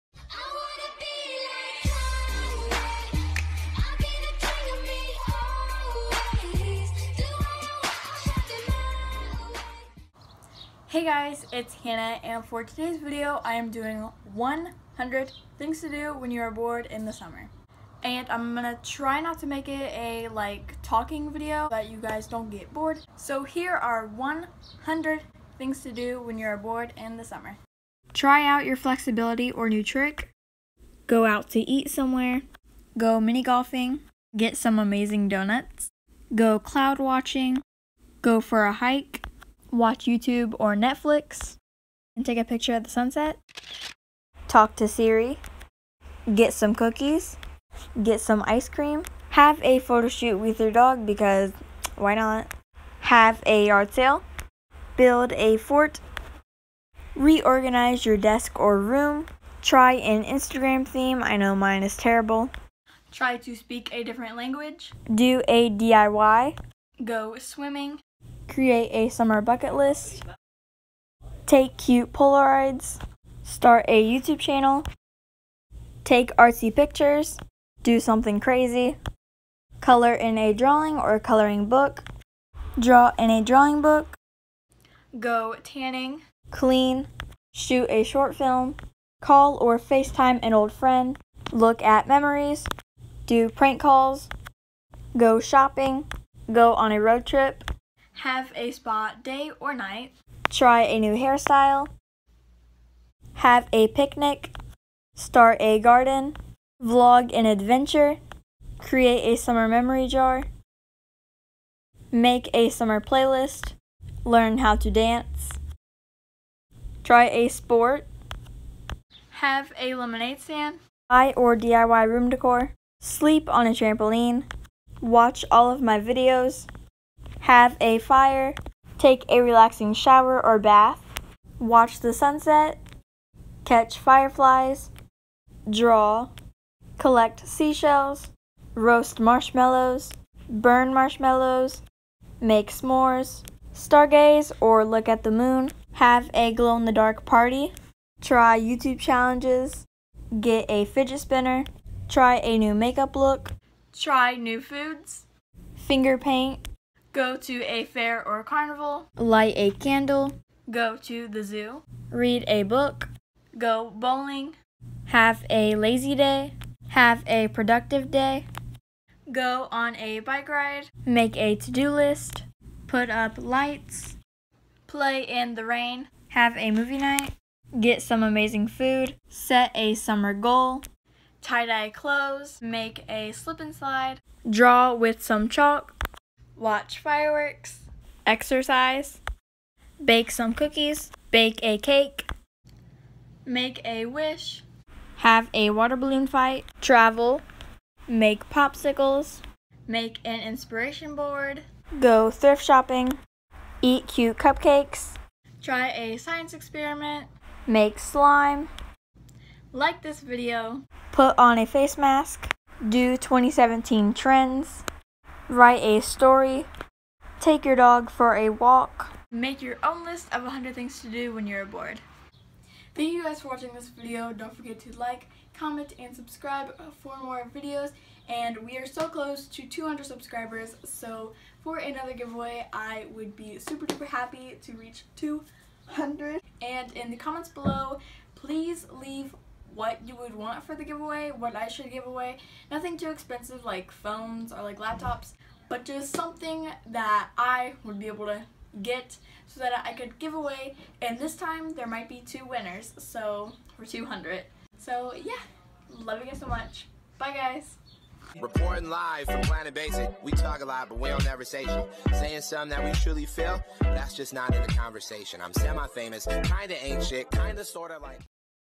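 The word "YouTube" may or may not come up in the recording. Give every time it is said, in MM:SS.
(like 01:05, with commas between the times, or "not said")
00:40, 01:14, 02:28.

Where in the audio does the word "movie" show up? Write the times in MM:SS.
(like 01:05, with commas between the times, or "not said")
02:56.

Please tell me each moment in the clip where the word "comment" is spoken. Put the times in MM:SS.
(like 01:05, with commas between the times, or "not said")
03:45, 03:57.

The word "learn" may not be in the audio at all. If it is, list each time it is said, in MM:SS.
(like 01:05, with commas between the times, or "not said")
01:54.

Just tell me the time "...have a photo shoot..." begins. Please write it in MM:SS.
00:49.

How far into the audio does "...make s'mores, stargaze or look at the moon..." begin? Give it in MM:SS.
02:22.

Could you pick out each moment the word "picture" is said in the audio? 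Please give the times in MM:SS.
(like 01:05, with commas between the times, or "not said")
00:42, 01:16.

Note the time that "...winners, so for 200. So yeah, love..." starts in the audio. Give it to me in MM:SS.
04:12.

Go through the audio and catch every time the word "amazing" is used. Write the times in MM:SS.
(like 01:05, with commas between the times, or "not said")
00:34, 02:58.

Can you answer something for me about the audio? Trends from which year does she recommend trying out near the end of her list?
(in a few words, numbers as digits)
2017.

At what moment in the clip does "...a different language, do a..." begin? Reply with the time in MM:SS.
01:03.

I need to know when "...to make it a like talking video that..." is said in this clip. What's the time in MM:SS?
00:19.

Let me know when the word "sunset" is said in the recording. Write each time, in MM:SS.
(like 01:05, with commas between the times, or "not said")
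00:42, 02:12.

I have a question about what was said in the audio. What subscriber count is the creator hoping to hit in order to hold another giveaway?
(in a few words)
200.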